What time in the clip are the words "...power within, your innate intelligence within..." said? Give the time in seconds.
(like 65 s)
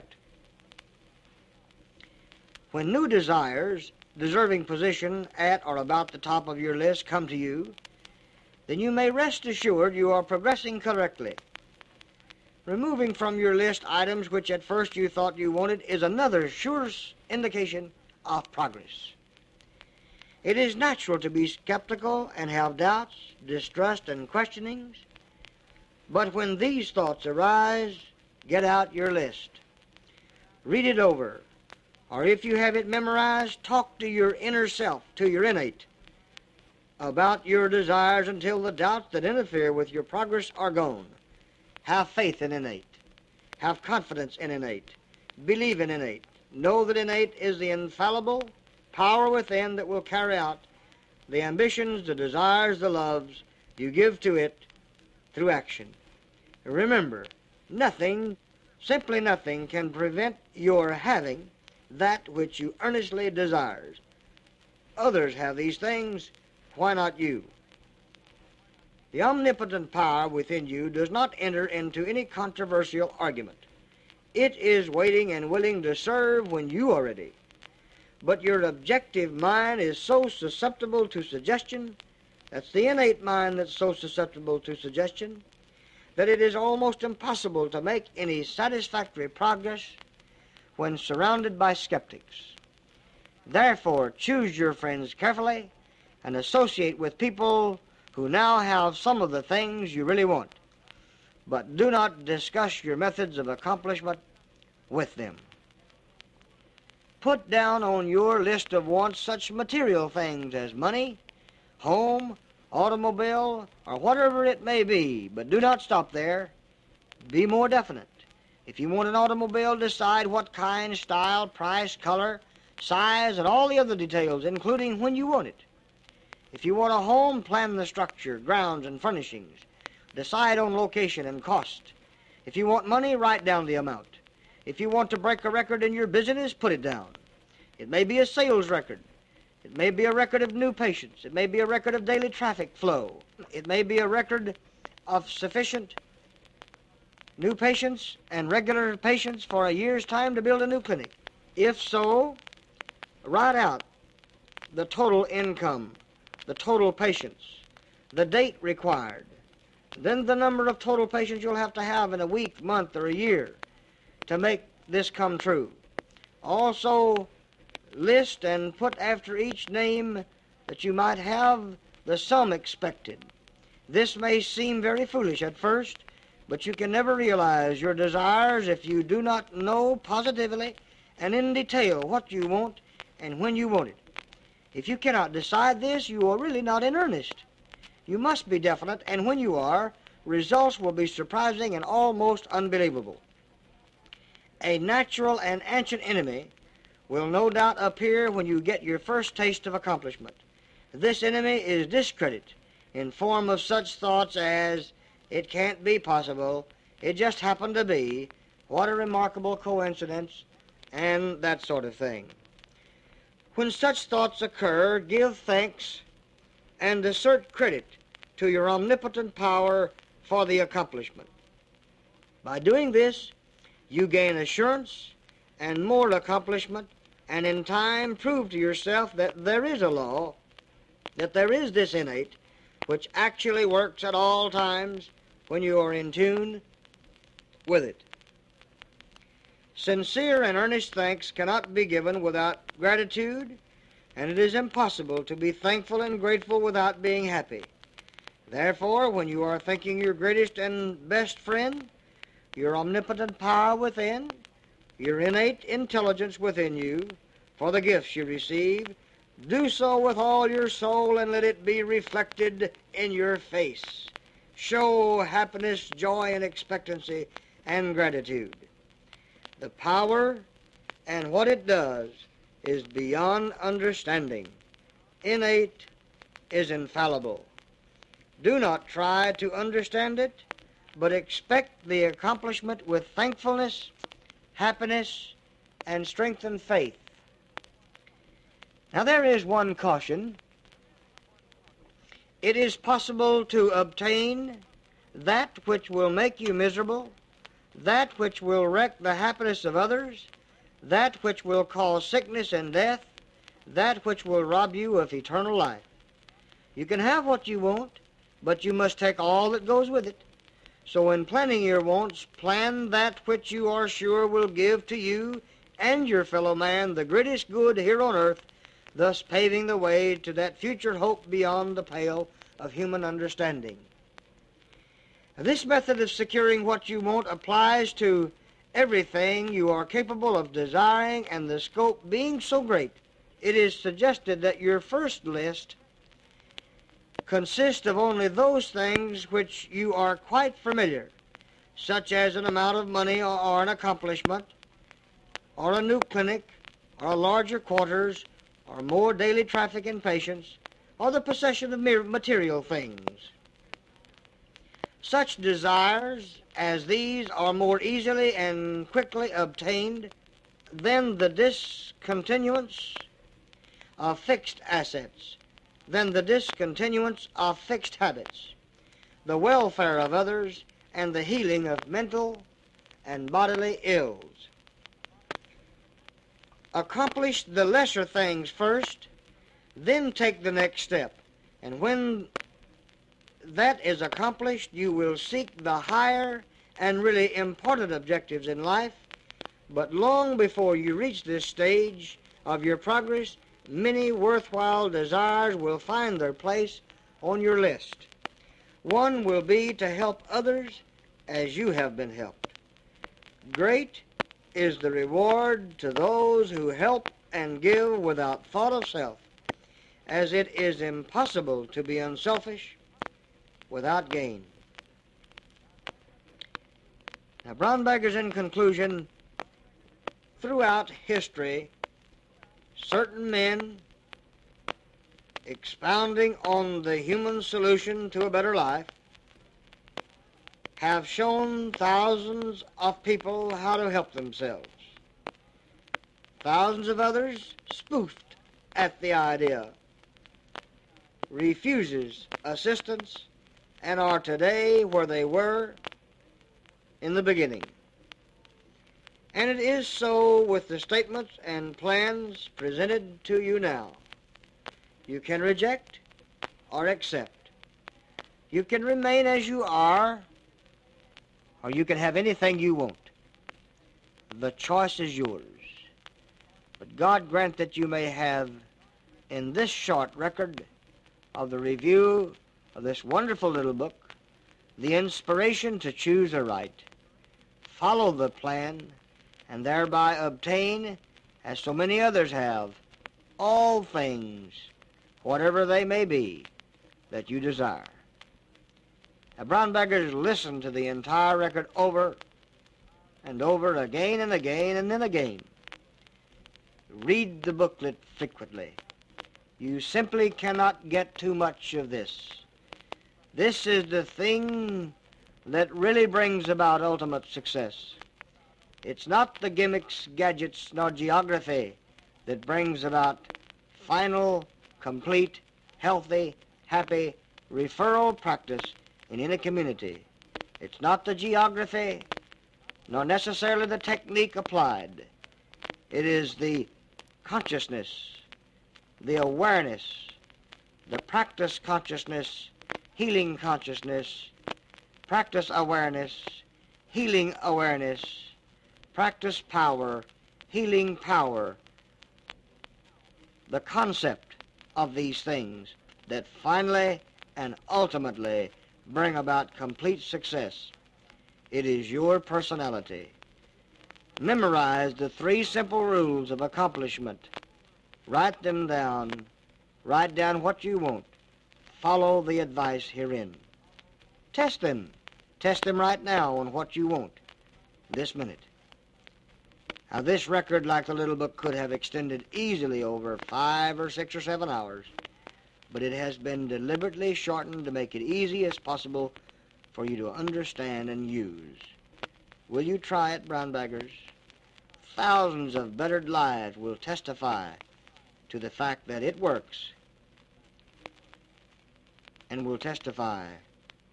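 253 s.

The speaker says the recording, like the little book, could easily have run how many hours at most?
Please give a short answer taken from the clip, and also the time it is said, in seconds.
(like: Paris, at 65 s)
7, at 574 s.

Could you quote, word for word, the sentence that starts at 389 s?
But long before you reach this stage of your progress, many worthwhile desires will find their place on your list.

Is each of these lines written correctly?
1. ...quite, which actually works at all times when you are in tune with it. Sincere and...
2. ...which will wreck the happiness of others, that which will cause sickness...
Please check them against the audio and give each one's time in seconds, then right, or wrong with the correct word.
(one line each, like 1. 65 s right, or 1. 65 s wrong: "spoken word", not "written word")
1. 231 s wrong: "innate", not "quite"
2. 298 s right.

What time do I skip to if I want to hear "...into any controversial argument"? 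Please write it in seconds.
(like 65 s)
71 s.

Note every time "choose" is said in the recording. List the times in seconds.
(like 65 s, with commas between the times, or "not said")
94 s, 475 s.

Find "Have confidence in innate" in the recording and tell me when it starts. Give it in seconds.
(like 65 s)
43 s.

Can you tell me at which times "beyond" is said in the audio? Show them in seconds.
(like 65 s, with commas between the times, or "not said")
272 s, 321 s.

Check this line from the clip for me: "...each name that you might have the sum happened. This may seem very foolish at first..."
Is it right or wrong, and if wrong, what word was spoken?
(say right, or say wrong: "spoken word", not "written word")
wrong: "expected", not "happened".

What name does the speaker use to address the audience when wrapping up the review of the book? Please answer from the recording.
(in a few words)
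Brownbaggers.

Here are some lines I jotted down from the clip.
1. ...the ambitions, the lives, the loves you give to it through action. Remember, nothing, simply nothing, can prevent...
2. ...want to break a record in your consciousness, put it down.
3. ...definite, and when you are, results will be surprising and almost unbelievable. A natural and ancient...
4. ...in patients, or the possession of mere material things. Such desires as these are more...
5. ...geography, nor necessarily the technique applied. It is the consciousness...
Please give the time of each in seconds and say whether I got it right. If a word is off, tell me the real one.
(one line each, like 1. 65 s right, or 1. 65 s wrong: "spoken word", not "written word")
1. 51 s wrong: "desires", not "lives"
2. 134 s wrong: "business", not "consciousness"
3. 188 s right
4. 349 s right
5. 521 s right.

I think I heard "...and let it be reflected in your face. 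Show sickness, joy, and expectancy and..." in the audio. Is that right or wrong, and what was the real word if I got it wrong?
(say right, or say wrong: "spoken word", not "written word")
wrong: "happiness", not "sickness".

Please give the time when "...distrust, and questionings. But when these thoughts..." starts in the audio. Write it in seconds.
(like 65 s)
23 s.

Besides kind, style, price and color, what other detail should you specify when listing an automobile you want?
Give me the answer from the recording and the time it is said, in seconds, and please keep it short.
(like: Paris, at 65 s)
Size, at 122 s.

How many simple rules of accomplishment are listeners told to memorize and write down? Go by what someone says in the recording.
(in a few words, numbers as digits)
3.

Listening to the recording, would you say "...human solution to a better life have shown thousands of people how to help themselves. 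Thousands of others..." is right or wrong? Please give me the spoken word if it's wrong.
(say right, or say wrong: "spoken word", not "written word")
right.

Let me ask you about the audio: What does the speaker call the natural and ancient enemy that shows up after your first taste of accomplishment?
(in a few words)
Discredit.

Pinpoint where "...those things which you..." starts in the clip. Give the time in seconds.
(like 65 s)
338 s.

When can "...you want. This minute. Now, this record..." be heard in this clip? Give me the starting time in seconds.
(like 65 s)
566 s.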